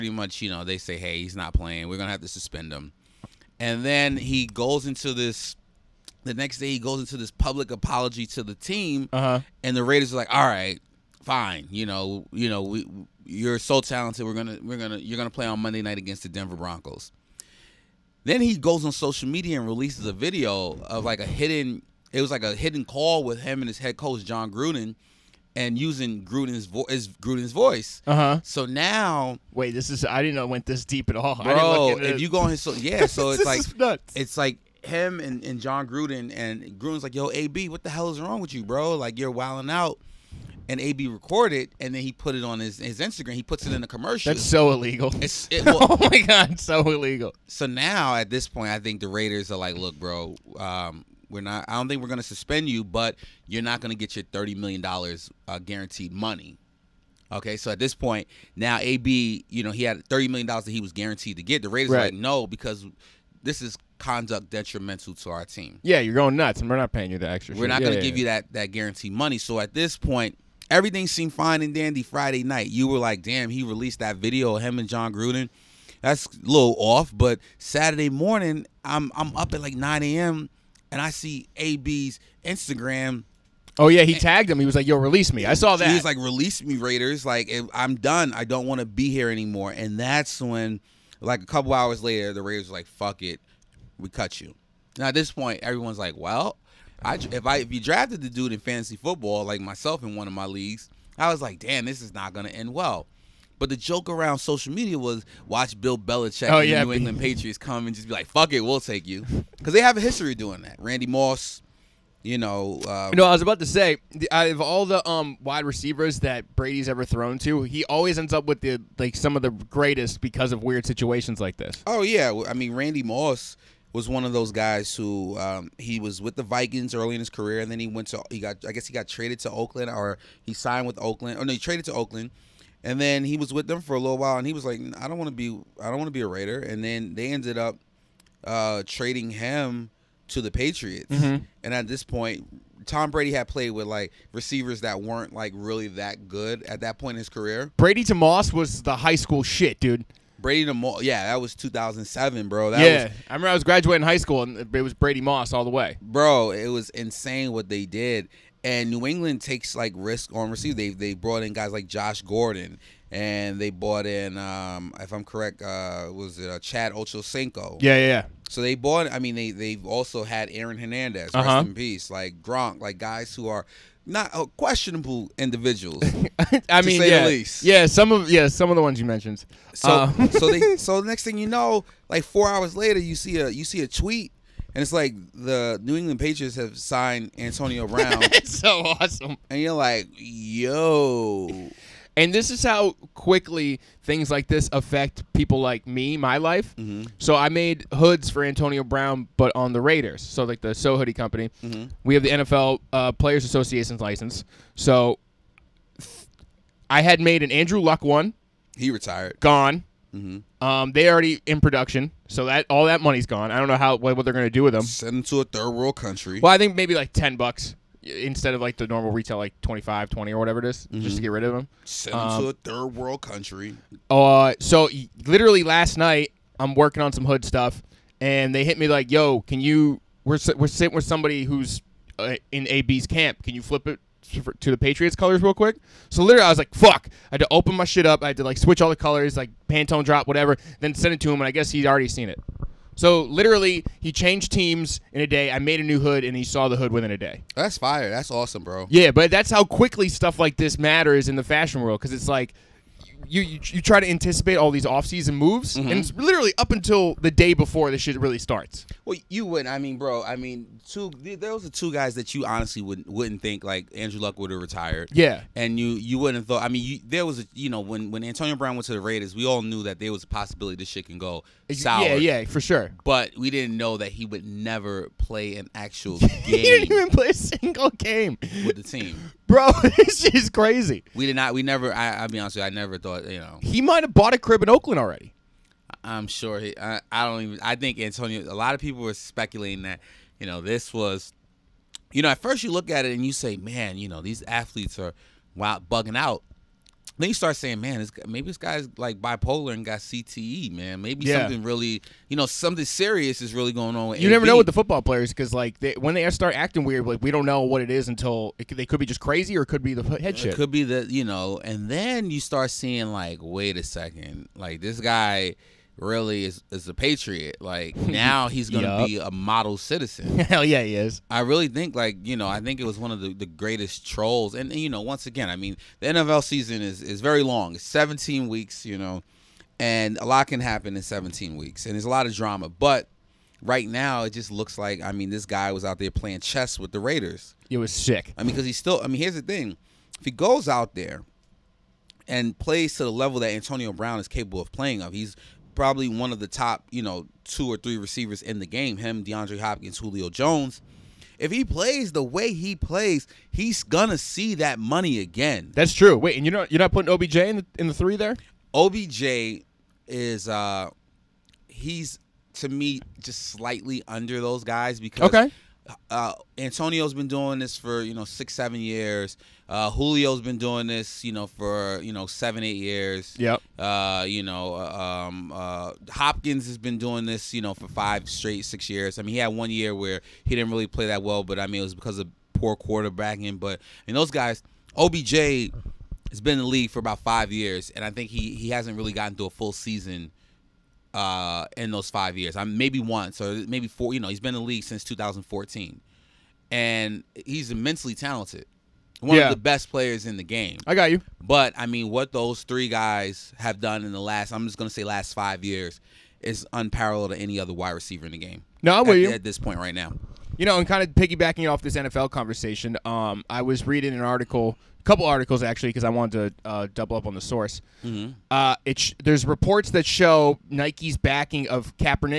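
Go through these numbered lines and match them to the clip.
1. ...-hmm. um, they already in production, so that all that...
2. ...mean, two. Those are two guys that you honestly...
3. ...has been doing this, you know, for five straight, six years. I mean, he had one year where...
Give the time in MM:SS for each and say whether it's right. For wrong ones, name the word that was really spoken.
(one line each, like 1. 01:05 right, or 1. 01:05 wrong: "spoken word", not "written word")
1. 03:30 right
2. 04:20 right
3. 06:16 right.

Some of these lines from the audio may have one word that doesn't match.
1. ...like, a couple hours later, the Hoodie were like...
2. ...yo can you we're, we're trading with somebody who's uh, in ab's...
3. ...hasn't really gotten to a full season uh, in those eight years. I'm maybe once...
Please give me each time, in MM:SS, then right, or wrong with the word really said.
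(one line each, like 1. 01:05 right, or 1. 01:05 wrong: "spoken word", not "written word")
1. 01:31 wrong: "Raiders", not "Hoodie"
2. 03:49 wrong: "sitting", not "trading"
3. 06:28 wrong: "five", not "eight".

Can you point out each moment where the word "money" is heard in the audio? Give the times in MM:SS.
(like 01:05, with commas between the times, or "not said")
00:56, 01:09, 03:33, 05:54.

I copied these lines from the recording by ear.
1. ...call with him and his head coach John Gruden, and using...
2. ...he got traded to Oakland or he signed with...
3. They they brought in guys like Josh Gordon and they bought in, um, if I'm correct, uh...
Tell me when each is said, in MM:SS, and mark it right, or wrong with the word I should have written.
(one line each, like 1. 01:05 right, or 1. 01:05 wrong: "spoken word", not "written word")
1. 00:22 right
2. 02:08 right
3. 02:40 right.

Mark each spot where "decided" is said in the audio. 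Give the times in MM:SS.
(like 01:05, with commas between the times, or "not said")
not said.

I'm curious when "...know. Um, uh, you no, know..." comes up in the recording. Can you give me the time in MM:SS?
01:52.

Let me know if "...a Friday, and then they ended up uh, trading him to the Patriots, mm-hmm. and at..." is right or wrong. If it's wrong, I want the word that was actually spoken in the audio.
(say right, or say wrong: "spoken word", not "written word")
wrong: "Raider", not "Friday".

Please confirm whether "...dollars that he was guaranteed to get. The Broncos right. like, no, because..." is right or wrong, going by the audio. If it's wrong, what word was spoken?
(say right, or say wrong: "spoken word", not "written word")
wrong: "Raiders", not "Broncos".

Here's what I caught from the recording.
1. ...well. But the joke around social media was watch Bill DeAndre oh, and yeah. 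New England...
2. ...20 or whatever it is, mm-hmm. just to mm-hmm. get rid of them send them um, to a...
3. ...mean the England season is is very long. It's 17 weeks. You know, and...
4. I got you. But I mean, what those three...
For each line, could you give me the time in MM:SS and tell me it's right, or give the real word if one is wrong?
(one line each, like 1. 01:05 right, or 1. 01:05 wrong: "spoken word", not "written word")
1. 01:42 wrong: "Belichick", not "DeAndre"
2. 03:40 right
3. 05:25 wrong: "NFL", not "England"
4. 06:40 right.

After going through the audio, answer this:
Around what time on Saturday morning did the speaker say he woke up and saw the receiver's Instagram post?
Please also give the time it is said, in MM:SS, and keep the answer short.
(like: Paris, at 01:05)
9 a.m., at 01:19.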